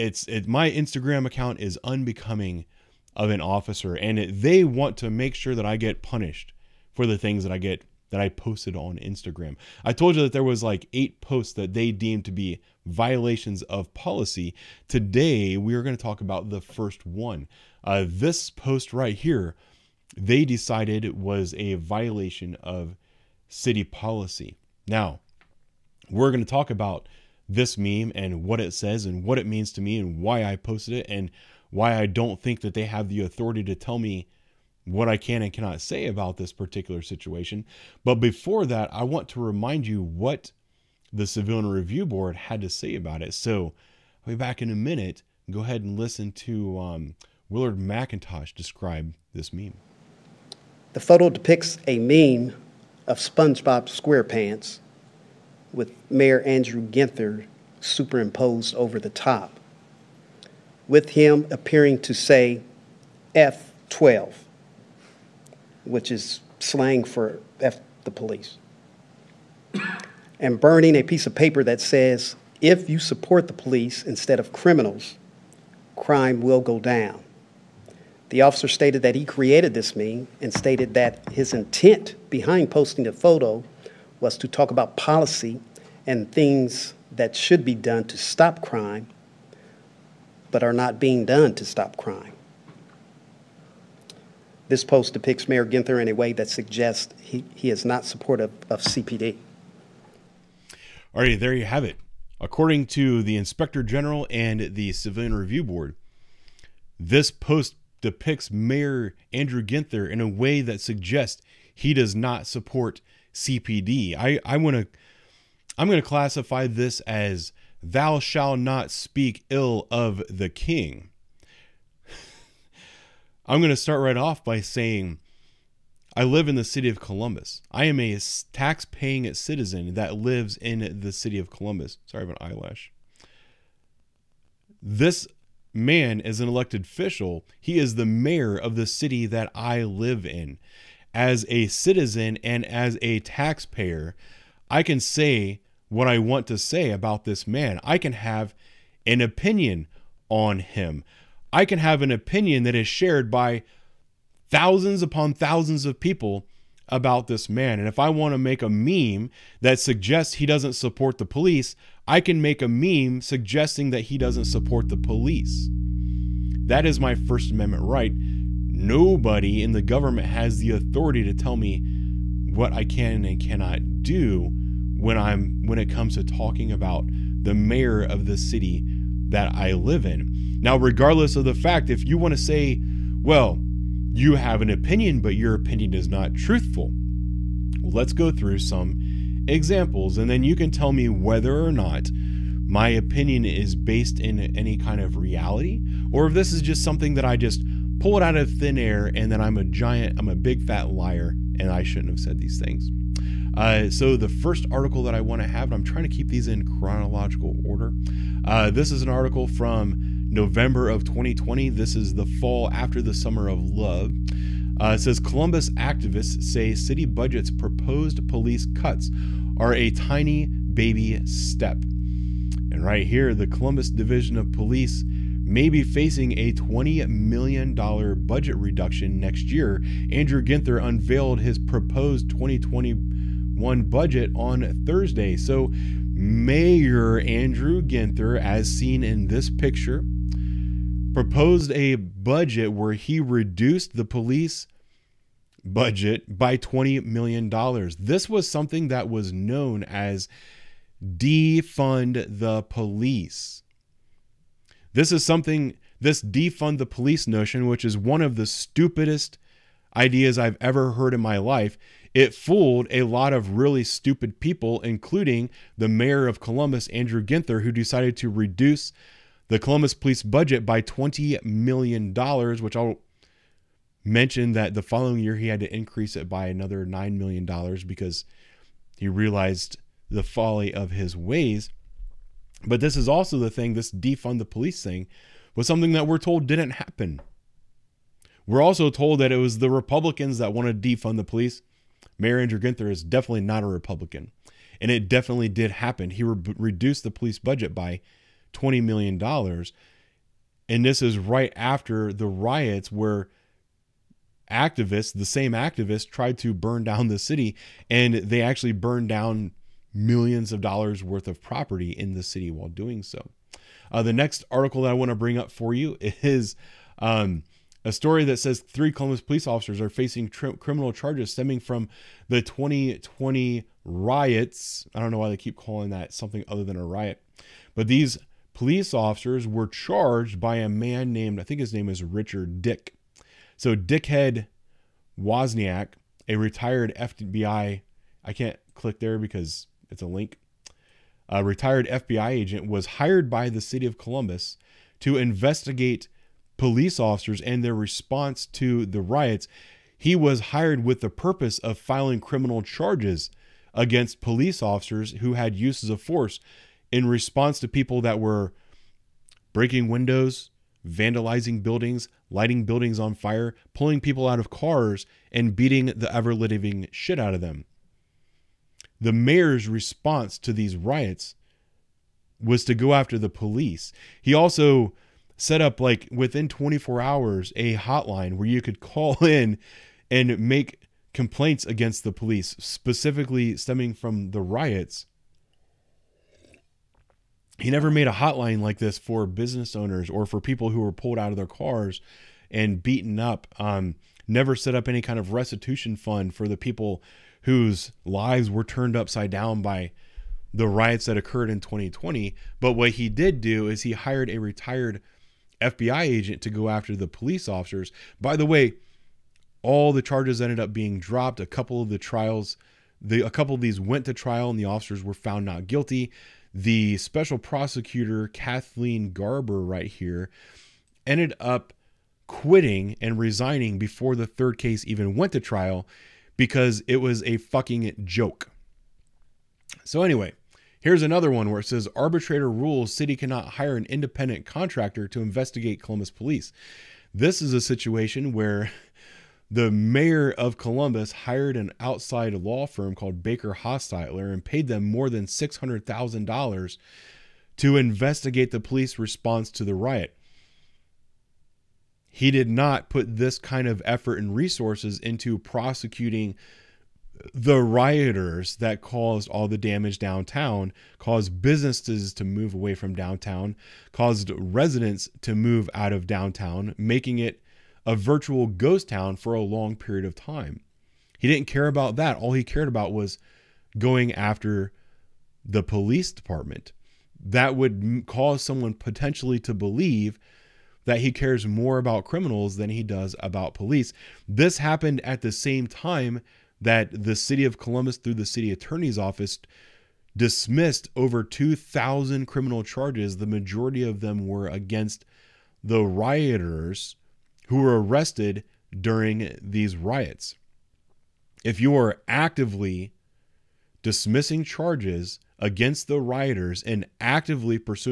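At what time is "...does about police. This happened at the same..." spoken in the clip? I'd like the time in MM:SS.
08:02.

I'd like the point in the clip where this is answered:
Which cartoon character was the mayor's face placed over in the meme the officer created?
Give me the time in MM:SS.
00:53.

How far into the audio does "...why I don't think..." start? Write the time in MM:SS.
00:31.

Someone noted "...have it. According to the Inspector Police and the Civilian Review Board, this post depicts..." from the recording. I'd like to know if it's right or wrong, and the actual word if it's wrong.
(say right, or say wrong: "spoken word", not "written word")
wrong: "General", not "Police".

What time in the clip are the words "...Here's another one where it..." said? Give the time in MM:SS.
07:10.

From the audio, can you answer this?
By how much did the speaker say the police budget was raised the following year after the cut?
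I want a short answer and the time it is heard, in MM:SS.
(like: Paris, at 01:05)
$9 million, at 04:36.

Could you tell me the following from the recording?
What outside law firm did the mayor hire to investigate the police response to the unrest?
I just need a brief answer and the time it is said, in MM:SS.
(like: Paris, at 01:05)
Baker Hostetler, at 07:23.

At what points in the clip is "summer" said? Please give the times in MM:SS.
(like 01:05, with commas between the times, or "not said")
03:33.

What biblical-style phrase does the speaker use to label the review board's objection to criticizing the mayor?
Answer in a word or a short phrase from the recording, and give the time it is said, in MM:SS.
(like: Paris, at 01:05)
thou shalt not speak ill of the king, at 01:57.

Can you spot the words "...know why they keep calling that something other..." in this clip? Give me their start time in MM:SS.
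05:25.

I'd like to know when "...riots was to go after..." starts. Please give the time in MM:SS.
06:10.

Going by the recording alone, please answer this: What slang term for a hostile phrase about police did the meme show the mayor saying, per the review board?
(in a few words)
F12.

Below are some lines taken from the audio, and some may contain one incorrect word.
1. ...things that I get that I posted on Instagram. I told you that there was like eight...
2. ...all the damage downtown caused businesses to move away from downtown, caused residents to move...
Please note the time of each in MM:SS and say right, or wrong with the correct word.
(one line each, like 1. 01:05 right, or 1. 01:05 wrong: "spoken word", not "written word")
1. 00:07 right
2. 07:39 right.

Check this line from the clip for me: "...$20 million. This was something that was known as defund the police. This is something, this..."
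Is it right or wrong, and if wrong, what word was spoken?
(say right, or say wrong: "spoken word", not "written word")
right.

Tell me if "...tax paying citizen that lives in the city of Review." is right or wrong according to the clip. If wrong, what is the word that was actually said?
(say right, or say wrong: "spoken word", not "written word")
wrong: "Columbus", not "Review".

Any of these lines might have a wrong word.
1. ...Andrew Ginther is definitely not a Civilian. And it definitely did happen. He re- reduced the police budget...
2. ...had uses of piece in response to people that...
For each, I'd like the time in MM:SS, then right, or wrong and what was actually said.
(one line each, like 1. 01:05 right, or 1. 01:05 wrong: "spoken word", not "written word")
1. 04:52 wrong: "Republican", not "Civilian"
2. 05:55 wrong: "force", not "piece".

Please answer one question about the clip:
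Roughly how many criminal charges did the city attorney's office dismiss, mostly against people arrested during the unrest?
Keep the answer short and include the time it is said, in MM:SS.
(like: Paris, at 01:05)
2,000, at 08:11.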